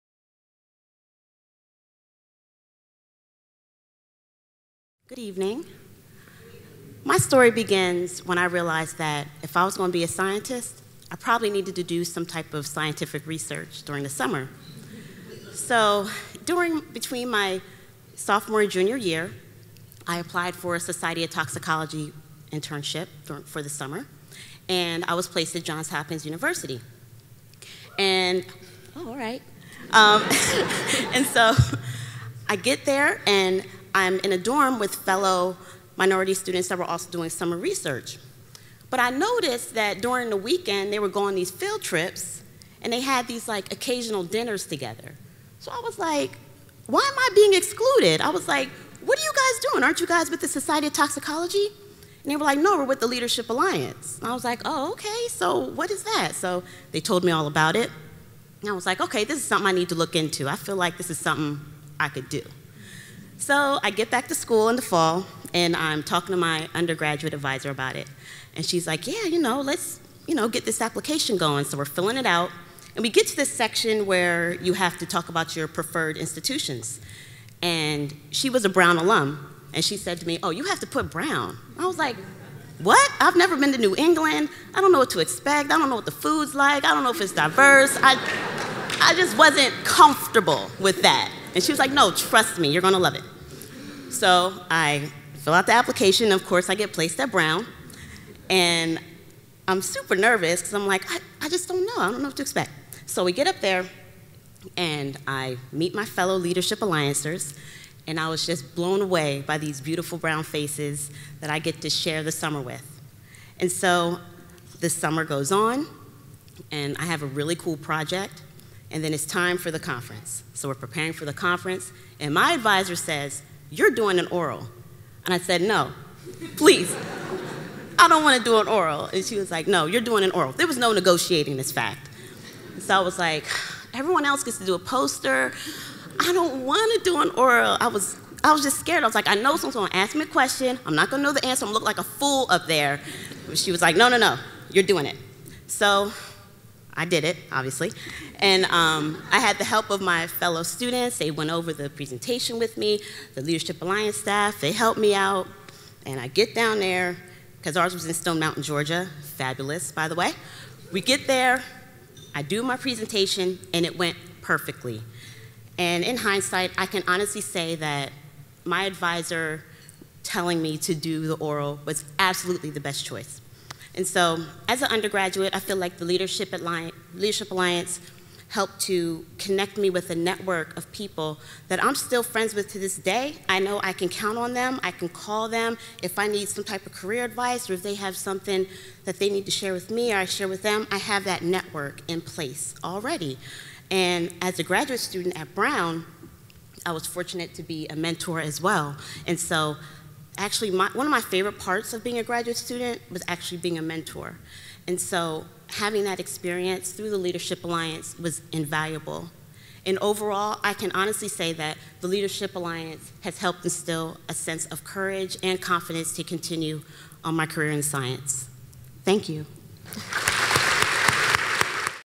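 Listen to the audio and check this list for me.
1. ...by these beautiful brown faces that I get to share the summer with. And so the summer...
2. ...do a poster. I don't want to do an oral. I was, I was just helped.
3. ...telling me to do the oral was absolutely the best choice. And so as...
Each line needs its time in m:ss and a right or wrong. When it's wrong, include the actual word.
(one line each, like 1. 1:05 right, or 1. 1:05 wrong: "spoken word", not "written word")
1. 1:49 right
2. 2:14 wrong: "scared", not "helped"
3. 2:50 right.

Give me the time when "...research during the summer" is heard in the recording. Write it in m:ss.
0:13.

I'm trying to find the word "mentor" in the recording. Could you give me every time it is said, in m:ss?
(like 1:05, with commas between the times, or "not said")
3:17, 3:23.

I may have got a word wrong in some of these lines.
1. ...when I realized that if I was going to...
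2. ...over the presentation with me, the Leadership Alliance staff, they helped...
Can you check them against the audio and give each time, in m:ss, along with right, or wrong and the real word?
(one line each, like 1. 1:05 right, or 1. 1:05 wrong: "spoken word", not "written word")
1. 0:08 right
2. 2:31 right.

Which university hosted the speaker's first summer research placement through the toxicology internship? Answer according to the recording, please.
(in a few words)
Johns Hopkins University.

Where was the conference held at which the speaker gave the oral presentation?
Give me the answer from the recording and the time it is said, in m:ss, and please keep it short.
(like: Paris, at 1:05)
Stone Mountain, Georgia, at 2:38.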